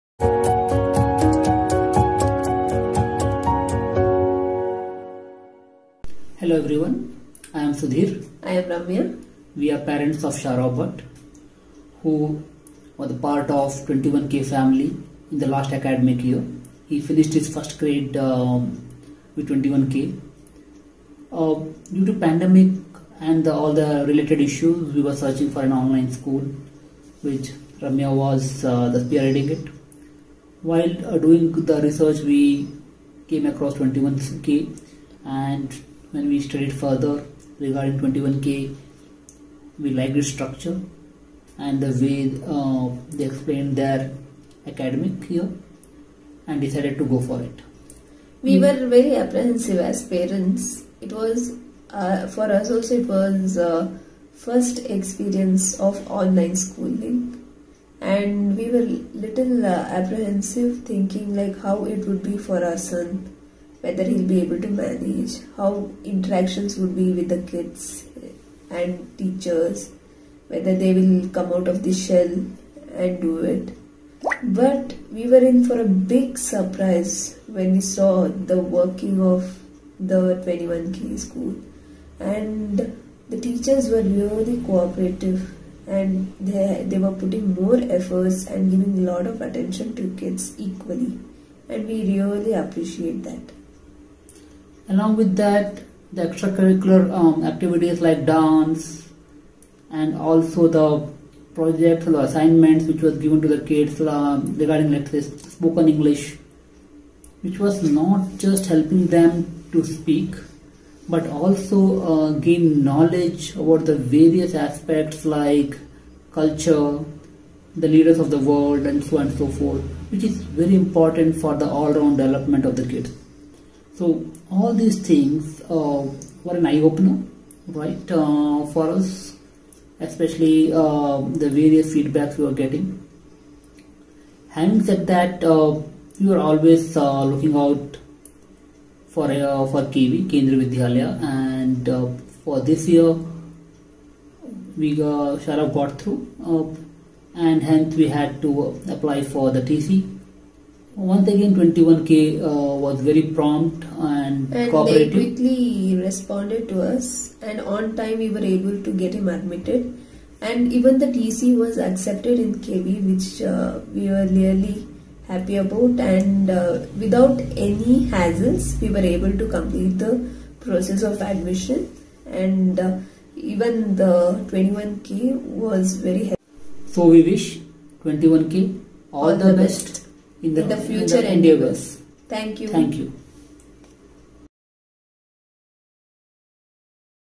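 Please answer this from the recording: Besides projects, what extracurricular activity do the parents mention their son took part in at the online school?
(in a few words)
Dance.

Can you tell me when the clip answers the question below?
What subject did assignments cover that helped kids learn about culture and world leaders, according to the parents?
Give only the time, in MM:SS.
01:45.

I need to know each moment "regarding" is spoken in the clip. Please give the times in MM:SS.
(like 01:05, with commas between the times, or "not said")
00:37, 01:44.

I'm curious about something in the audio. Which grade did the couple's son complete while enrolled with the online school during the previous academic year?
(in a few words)
First grade.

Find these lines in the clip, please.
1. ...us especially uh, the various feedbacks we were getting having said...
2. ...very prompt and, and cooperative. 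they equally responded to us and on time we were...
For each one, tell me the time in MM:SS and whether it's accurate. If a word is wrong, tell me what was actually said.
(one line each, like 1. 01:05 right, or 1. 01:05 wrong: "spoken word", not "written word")
1. 02:08 right
2. 02:33 wrong: "quickly", not "equally".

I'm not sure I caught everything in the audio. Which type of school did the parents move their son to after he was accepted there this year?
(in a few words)
Kendriya Vidyalaya.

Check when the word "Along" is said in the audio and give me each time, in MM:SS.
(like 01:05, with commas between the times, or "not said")
01:34.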